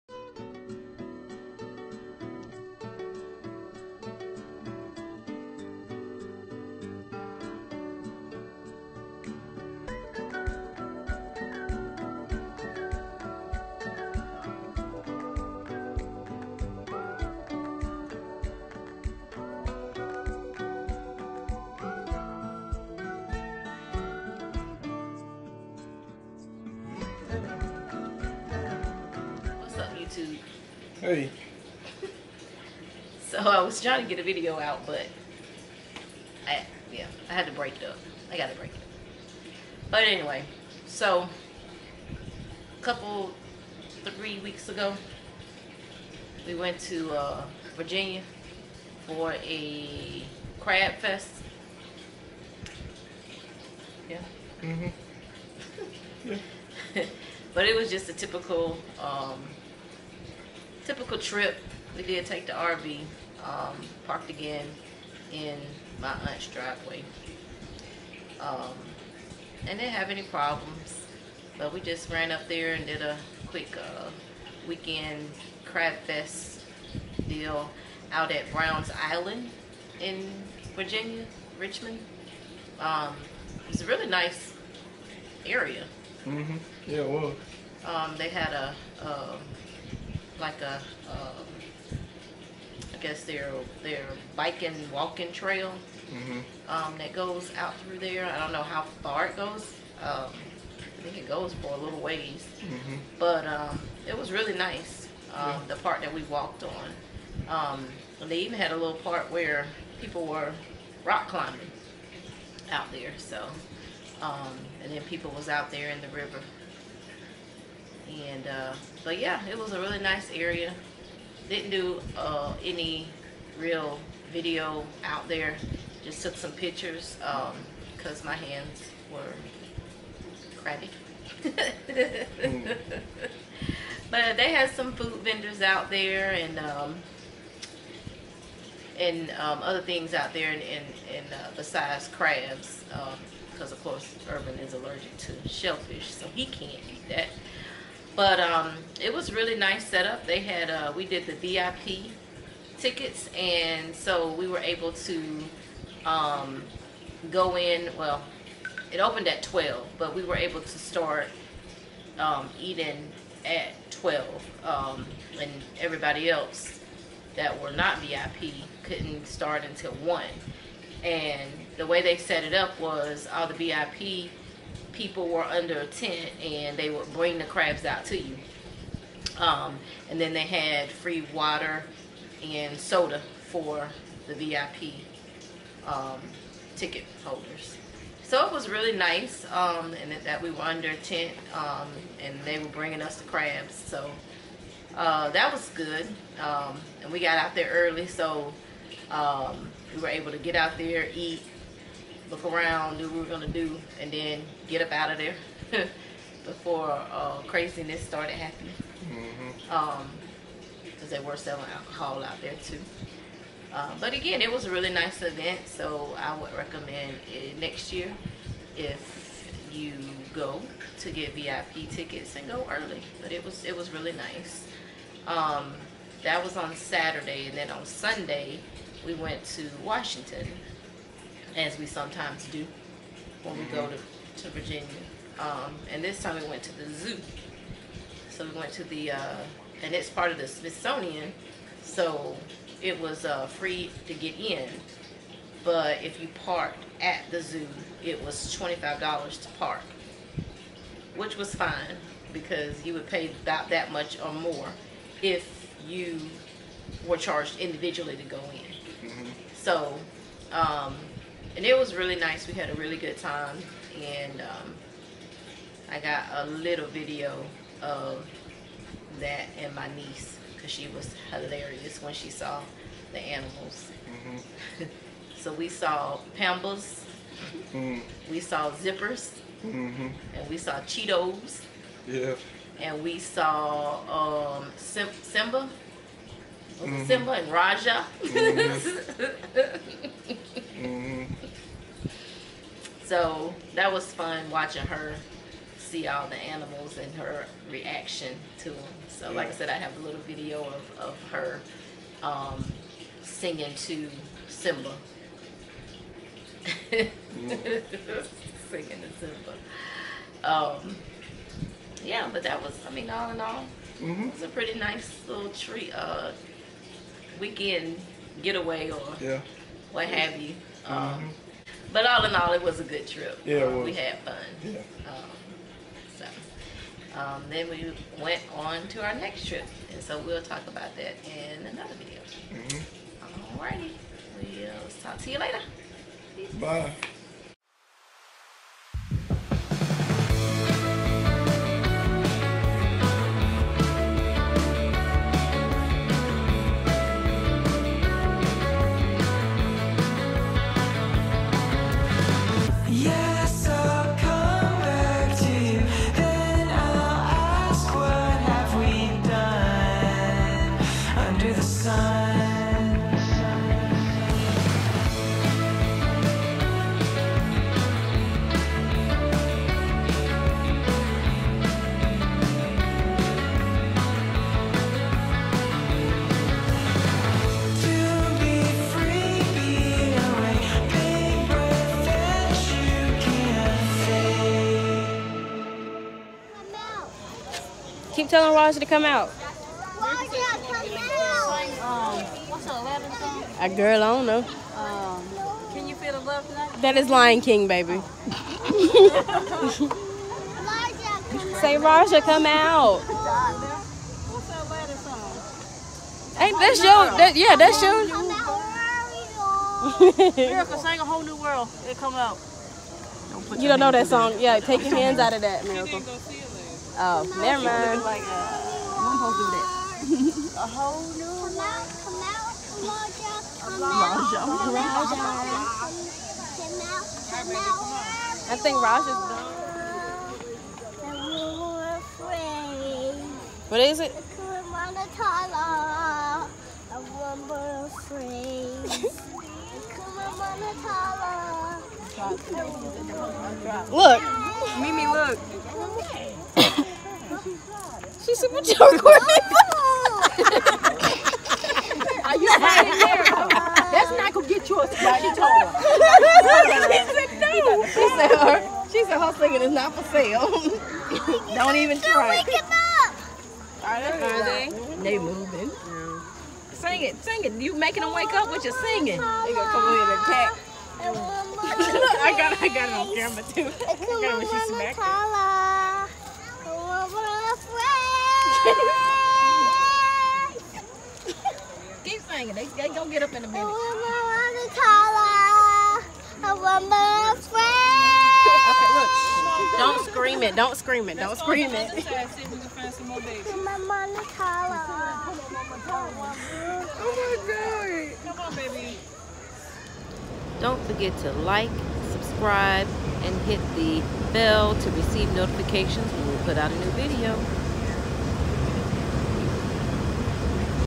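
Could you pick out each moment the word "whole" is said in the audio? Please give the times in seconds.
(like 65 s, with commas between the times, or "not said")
411 s, 420 s.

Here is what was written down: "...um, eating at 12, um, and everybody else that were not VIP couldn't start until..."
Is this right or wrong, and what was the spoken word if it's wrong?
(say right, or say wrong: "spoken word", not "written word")
right.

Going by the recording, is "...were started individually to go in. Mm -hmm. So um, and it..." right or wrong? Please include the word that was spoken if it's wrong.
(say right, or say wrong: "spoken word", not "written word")
wrong: "charged", not "started".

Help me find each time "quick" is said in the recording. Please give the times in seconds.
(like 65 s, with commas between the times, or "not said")
73 s.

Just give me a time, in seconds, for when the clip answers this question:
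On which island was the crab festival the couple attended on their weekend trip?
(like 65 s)
78 s.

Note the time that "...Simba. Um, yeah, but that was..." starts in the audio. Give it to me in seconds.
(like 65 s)
309 s.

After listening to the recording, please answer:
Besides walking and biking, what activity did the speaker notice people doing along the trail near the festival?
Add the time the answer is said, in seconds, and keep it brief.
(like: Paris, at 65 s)
rock climbing, at 111 s.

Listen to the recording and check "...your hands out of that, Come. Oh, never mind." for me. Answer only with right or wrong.
wrong.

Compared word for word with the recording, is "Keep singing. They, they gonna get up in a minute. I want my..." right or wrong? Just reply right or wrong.
right.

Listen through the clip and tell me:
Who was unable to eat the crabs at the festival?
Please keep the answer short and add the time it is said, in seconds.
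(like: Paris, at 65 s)
Urban, at 144 s.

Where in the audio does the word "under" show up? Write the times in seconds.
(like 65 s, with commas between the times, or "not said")
175 s, 190 s.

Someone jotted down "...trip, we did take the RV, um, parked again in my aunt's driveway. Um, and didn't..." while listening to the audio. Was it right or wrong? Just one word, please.
right.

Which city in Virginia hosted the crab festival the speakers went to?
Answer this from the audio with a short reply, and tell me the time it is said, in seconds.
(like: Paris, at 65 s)
Richmond, at 81 s.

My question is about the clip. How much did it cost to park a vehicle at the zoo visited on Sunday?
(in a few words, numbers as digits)
$25.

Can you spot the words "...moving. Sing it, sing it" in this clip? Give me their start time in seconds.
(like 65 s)
465 s.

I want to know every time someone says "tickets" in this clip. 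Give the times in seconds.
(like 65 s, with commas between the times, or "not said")
152 s, 186 s, 221 s.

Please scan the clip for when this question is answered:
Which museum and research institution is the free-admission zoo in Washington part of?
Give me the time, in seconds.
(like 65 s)
240 s.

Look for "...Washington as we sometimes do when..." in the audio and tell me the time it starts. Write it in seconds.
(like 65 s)
229 s.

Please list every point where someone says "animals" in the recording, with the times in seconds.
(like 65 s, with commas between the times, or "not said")
273 s, 296 s.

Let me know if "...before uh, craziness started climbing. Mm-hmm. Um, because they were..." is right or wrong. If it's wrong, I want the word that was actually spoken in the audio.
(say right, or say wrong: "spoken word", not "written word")
wrong: "happening", not "climbing".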